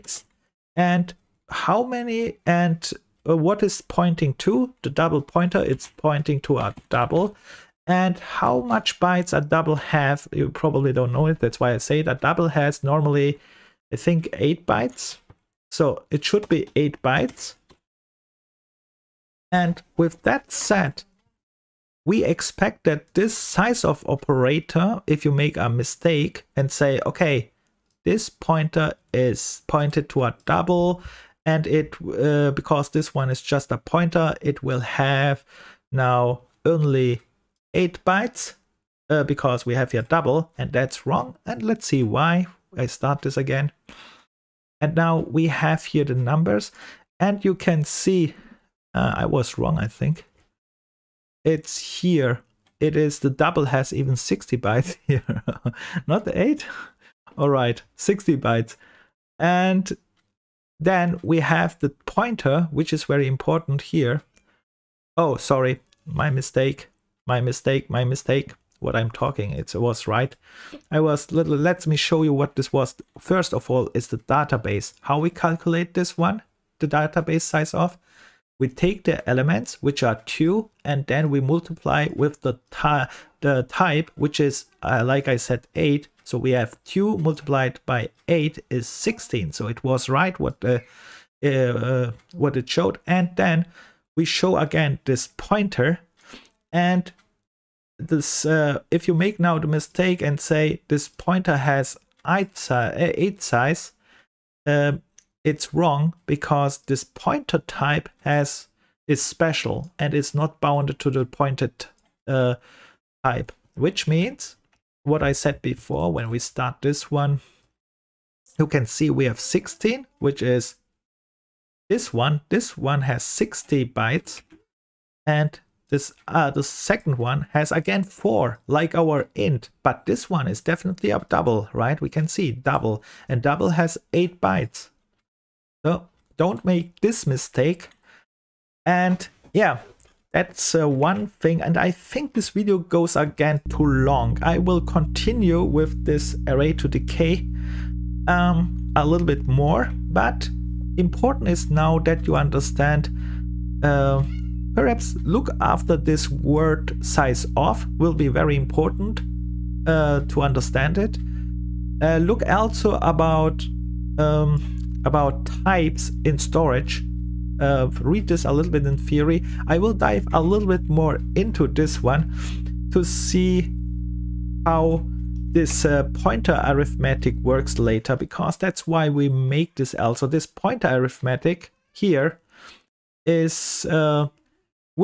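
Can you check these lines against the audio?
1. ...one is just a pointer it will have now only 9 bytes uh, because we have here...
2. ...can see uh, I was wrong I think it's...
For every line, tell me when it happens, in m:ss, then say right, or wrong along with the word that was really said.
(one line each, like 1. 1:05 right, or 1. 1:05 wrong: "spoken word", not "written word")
1. 0:33 wrong: "8", not "9"
2. 0:47 right.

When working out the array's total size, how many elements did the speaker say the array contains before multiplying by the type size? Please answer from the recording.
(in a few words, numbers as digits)
2.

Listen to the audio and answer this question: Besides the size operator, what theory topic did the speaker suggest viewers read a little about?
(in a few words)
types in storage.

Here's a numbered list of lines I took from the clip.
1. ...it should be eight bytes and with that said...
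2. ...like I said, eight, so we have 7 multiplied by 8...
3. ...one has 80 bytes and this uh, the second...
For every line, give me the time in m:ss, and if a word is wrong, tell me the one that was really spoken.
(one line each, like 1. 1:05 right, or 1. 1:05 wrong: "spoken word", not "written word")
1. 0:16 right
2. 1:25 wrong: "2", not "7"
3. 2:02 wrong: "60", not "80".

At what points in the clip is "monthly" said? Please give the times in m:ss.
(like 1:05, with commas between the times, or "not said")
not said.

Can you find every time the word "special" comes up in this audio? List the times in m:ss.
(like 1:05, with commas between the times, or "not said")
1:49.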